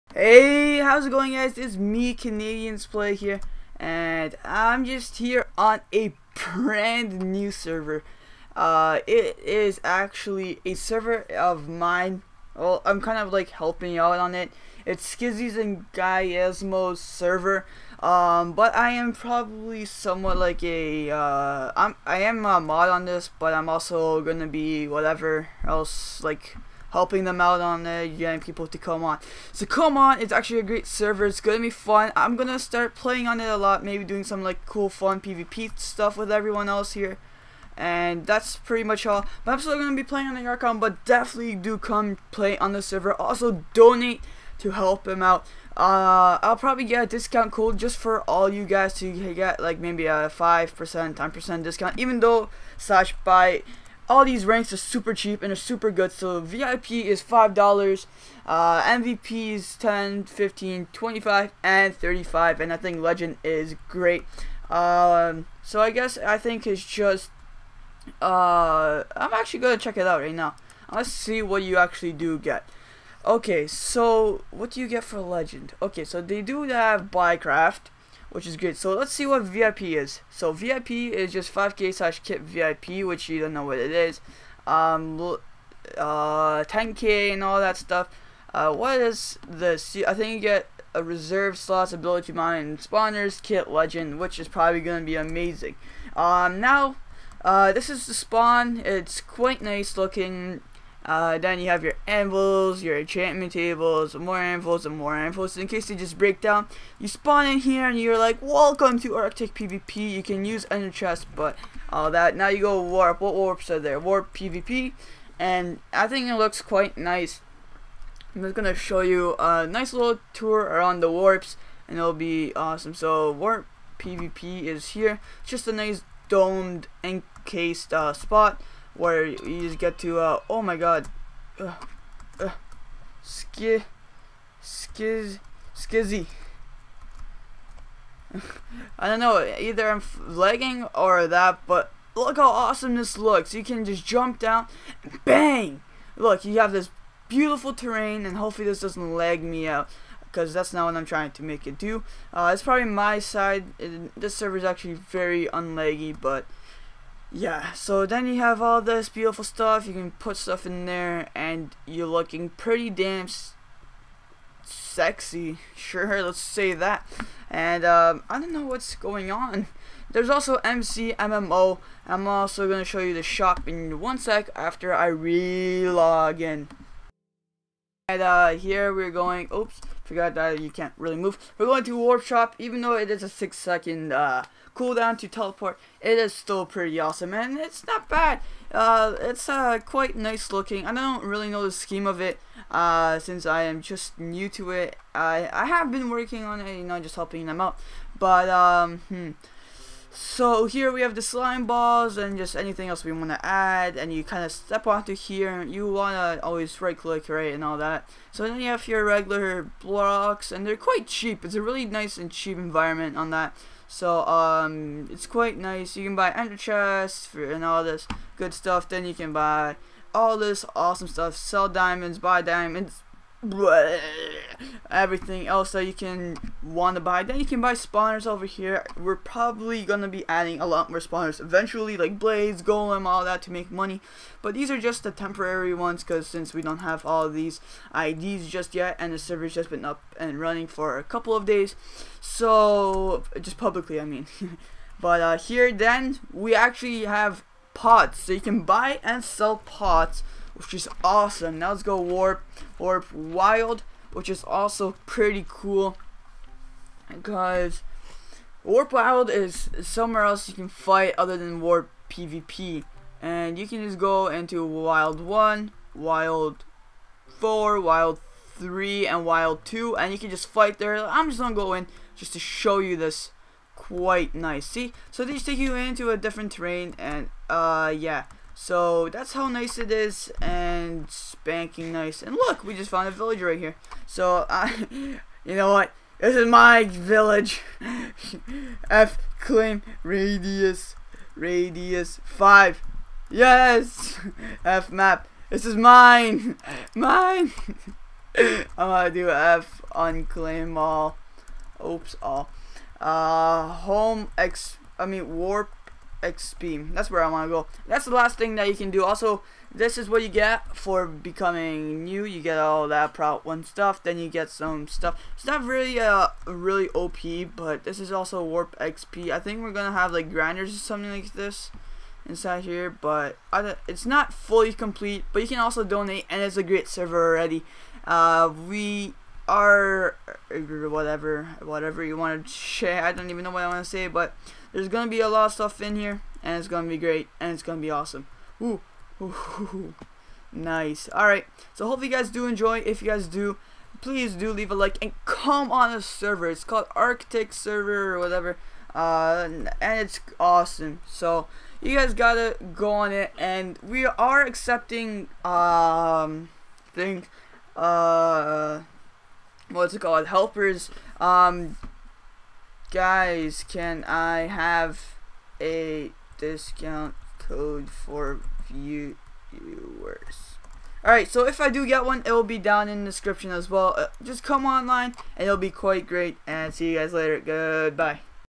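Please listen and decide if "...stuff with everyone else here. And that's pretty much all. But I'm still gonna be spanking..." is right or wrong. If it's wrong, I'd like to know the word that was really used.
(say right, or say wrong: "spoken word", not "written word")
wrong: "playing", not "spanking".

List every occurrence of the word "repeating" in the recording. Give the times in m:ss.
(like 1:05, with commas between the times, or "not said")
not said.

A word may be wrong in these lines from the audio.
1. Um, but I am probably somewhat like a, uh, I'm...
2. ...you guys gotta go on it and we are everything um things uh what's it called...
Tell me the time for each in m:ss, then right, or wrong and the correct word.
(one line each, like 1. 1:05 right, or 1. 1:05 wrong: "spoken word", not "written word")
1. 0:18 right
2. 5:51 wrong: "accepting", not "everything".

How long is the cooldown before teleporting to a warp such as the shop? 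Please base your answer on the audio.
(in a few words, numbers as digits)
6 seconds.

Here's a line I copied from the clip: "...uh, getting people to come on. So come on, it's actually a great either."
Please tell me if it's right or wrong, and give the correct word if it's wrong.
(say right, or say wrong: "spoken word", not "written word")
wrong: "server", not "either".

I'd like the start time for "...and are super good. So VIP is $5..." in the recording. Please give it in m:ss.
0:55.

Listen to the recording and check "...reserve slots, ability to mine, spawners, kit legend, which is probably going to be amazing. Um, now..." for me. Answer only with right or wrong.
right.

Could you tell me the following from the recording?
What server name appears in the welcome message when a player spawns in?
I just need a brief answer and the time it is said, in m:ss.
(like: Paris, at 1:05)
Arctic PvP, at 1:49.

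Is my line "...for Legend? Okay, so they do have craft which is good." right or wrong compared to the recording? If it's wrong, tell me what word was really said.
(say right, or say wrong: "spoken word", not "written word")
right.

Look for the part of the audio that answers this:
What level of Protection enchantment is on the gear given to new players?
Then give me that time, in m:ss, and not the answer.
5:13.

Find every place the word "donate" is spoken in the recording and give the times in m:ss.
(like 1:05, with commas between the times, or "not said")
0:43, 5:25.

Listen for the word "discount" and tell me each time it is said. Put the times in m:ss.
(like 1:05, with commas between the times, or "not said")
0:47, 0:51, 6:06.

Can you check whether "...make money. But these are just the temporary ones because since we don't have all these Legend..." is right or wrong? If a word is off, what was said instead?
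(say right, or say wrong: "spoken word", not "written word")
wrong: "IDs", not "Legend".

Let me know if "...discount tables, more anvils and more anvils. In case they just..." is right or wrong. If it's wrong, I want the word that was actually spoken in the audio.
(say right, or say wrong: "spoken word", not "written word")
wrong: "enchantment", not "discount".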